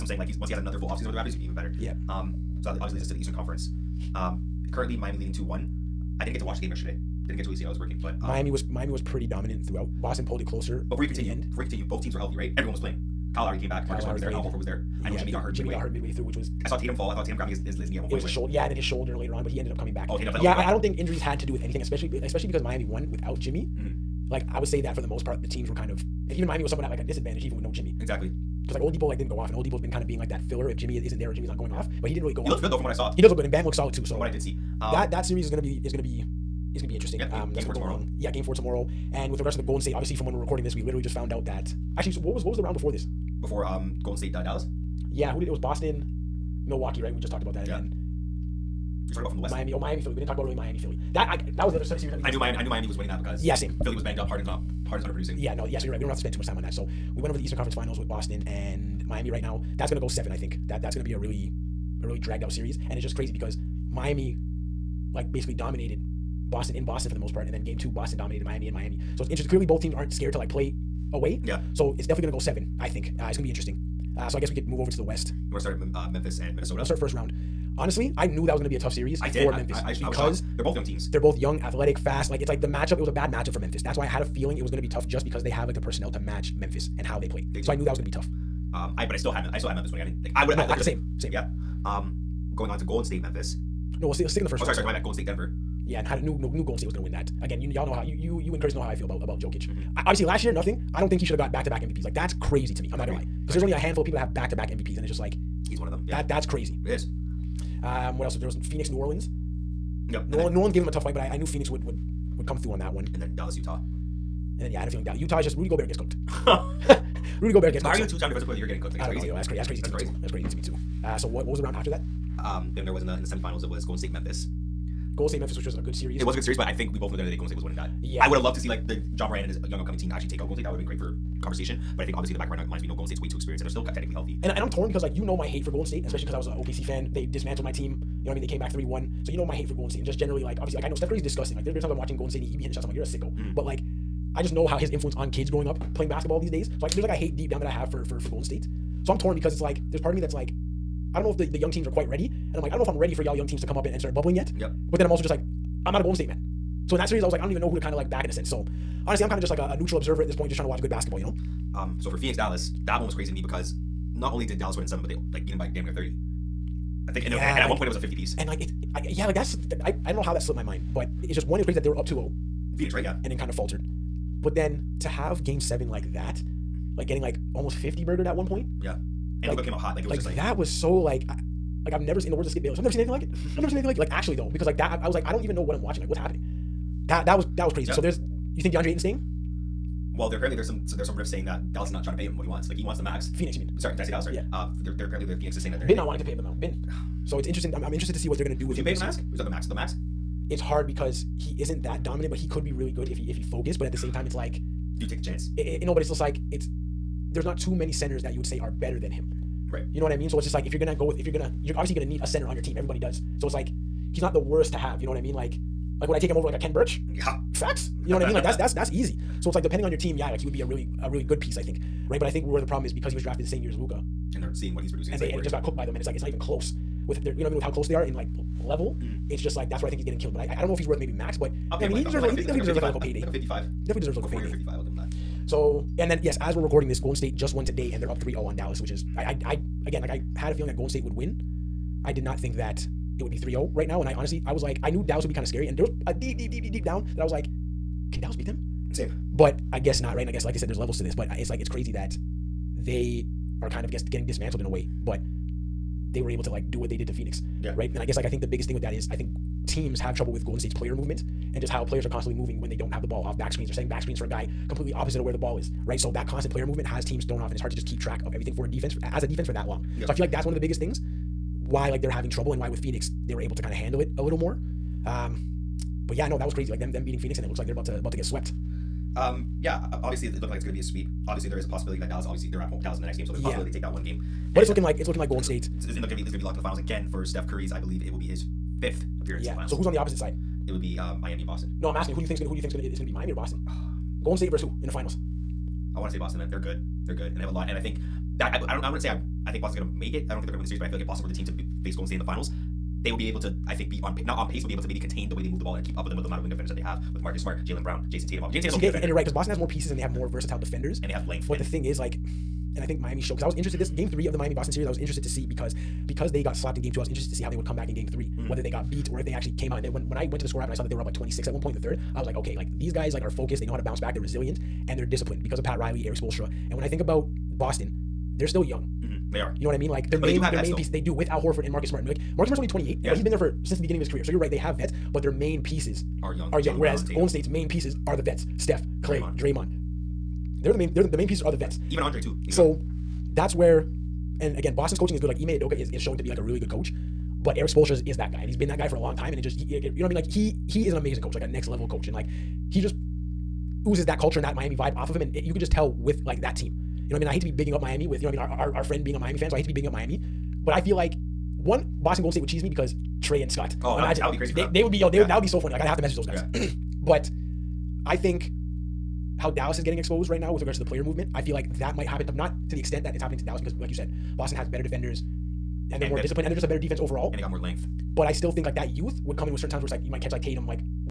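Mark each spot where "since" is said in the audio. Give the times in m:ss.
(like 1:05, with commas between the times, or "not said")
5:33.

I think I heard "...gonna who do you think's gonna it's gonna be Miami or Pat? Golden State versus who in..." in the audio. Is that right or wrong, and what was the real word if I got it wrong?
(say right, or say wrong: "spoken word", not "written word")
wrong: "Boston", not "Pat".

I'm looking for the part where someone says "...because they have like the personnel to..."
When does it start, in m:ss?
1:25.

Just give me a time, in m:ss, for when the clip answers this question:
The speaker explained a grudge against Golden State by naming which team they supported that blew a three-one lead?
2:16.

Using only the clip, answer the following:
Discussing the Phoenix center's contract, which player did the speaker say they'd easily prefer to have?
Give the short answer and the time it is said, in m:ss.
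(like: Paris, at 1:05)
Ken Birch, at 3:36.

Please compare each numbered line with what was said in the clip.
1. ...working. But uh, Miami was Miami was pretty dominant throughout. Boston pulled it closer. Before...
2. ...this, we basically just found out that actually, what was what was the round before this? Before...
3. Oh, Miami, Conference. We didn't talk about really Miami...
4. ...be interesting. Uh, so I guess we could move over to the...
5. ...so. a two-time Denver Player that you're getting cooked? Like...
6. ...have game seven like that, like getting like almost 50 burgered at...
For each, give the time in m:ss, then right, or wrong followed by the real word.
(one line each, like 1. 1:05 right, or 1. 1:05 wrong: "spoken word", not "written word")
1. 0:07 right
2. 0:40 wrong: "literally", not "basically"
3. 0:49 wrong: "Philly", not "Conference"
4. 1:13 right
5. 1:58 wrong: "Defensive", not "Denver"
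6. 2:55 right.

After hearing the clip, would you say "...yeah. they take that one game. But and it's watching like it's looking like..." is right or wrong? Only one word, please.
wrong.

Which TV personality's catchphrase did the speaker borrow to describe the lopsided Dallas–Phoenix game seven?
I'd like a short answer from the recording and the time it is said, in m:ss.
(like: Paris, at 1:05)
Skip Bayless, at 3:02.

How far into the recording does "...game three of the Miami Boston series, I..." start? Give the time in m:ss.
5:13.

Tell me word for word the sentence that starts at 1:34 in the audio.
No, we'll, see, we'll stick in the first.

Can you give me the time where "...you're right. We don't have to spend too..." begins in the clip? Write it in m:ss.
0:55.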